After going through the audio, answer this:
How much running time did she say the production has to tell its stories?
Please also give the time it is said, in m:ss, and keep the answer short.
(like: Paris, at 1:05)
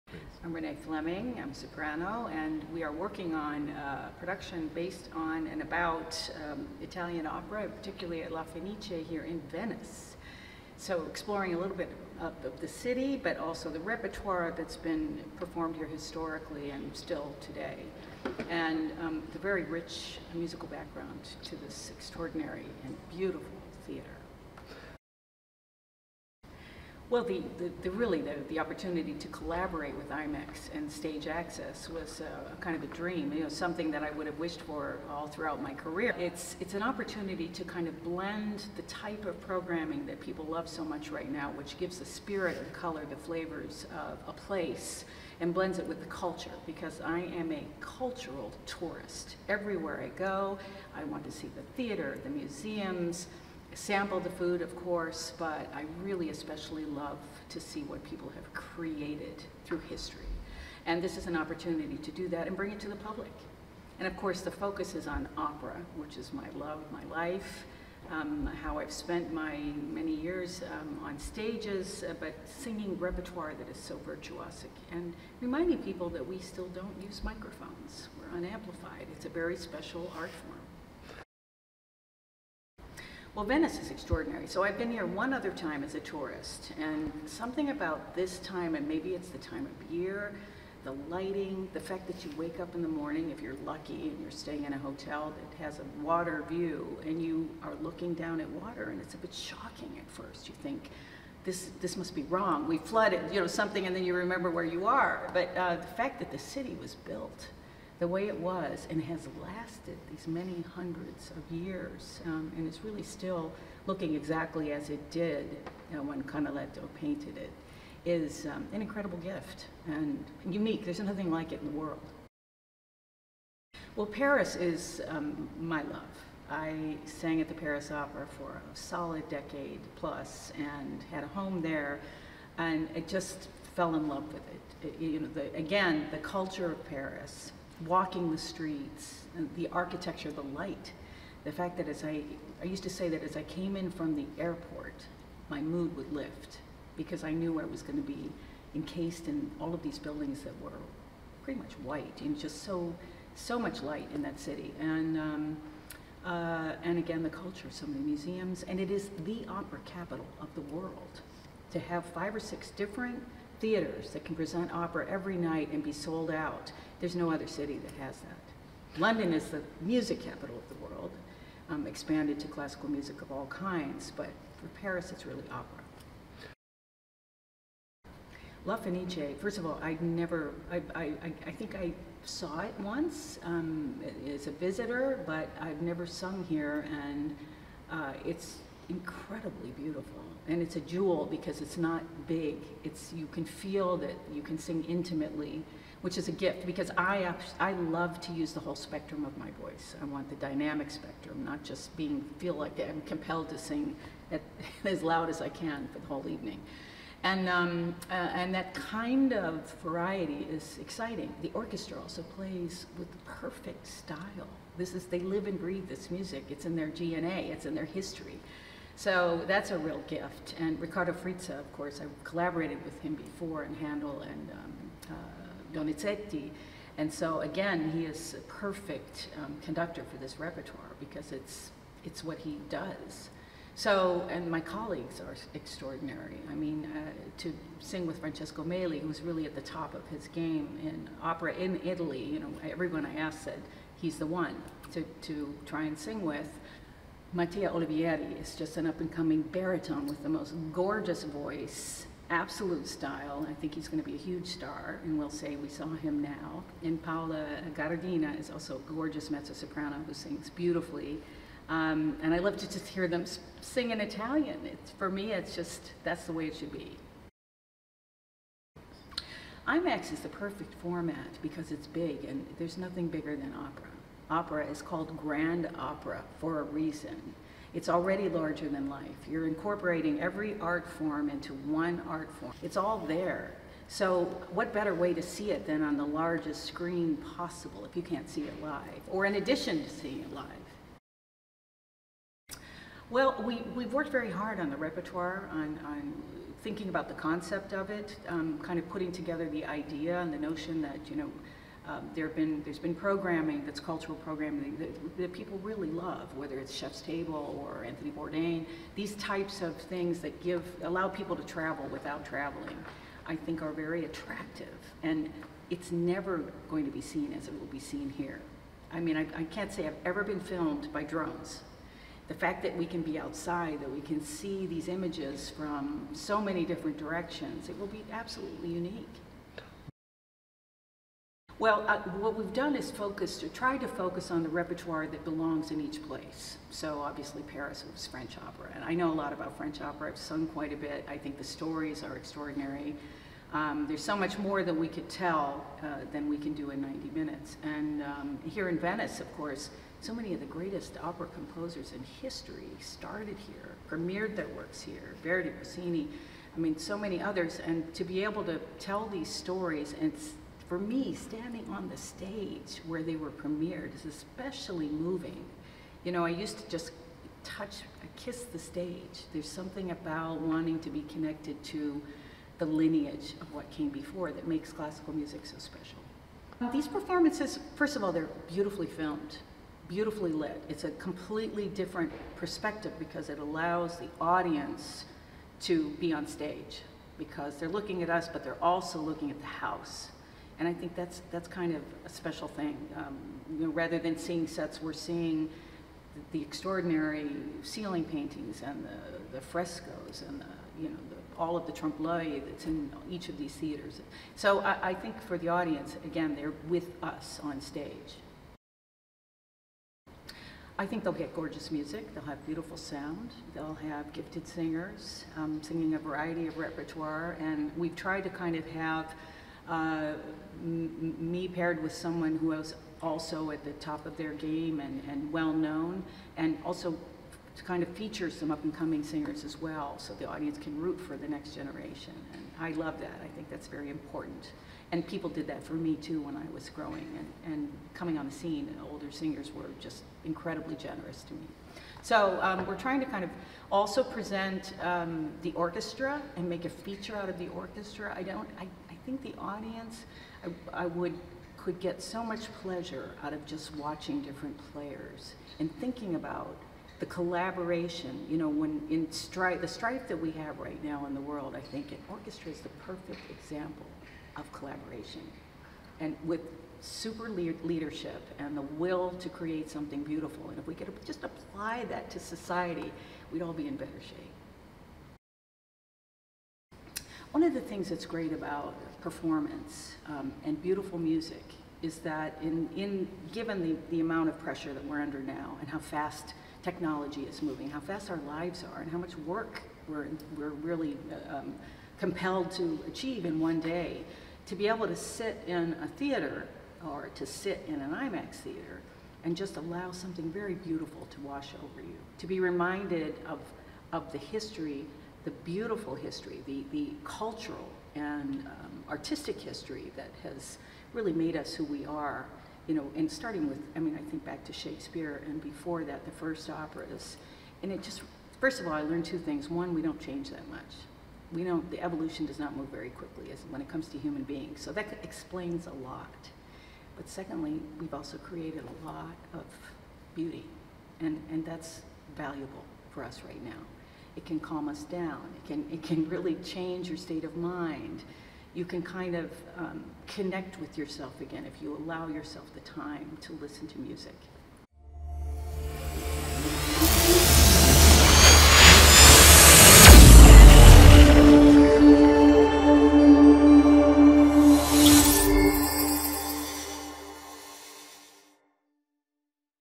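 90 minutes, at 5:46.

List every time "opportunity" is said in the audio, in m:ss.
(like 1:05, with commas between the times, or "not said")
0:28, 0:36, 1:01.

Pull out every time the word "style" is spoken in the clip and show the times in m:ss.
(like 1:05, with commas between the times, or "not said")
3:33, 4:12.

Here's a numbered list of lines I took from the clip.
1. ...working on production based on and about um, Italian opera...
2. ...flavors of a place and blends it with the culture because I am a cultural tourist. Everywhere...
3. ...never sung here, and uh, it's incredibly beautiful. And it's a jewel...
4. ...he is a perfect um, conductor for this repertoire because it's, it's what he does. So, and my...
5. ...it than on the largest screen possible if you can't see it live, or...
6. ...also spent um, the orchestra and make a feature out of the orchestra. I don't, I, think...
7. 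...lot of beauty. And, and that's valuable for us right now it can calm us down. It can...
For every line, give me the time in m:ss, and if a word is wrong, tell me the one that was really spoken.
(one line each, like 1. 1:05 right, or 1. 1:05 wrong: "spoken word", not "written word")
1. 0:02 right
2. 0:43 right
3. 3:05 right
4. 3:47 right
5. 4:45 right
6. 7:23 wrong: "present", not "spent"
7. 8:48 right.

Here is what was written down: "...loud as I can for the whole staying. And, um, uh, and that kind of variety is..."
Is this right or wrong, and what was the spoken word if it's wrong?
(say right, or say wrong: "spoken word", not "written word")
wrong: "evening", not "staying".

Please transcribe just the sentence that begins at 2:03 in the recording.
Well, Paris is um, my love.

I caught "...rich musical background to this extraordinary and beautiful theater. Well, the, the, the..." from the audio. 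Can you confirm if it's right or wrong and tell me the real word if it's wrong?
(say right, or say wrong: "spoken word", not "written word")
right.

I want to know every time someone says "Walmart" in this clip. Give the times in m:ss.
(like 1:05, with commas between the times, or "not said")
not said.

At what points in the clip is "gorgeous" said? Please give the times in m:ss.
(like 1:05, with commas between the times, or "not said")
4:10, 4:18, 6:51.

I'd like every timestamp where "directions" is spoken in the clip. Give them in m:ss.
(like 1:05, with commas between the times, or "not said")
5:26.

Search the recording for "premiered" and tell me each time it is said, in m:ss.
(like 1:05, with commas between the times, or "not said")
5:53, 6:03.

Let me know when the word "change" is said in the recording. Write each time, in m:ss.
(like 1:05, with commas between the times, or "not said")
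8:39, 8:56.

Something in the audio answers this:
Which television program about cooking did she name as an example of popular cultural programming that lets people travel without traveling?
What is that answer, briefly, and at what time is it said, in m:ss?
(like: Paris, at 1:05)
Chef's Table, at 5:06.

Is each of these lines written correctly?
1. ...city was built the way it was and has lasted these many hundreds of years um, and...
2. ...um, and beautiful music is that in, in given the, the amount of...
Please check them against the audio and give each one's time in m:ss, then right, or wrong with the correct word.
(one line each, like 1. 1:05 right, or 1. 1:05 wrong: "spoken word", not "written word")
1. 1:46 right
2. 8:00 right.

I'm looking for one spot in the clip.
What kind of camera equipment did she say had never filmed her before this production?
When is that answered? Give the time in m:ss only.
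5:21.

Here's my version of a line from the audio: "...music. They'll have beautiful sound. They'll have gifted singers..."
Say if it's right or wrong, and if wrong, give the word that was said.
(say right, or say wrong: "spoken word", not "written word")
right.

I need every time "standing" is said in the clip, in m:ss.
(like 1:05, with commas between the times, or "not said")
6:01.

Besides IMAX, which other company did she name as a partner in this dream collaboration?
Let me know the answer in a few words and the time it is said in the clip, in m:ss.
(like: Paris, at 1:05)
Stage Access, at 0:30.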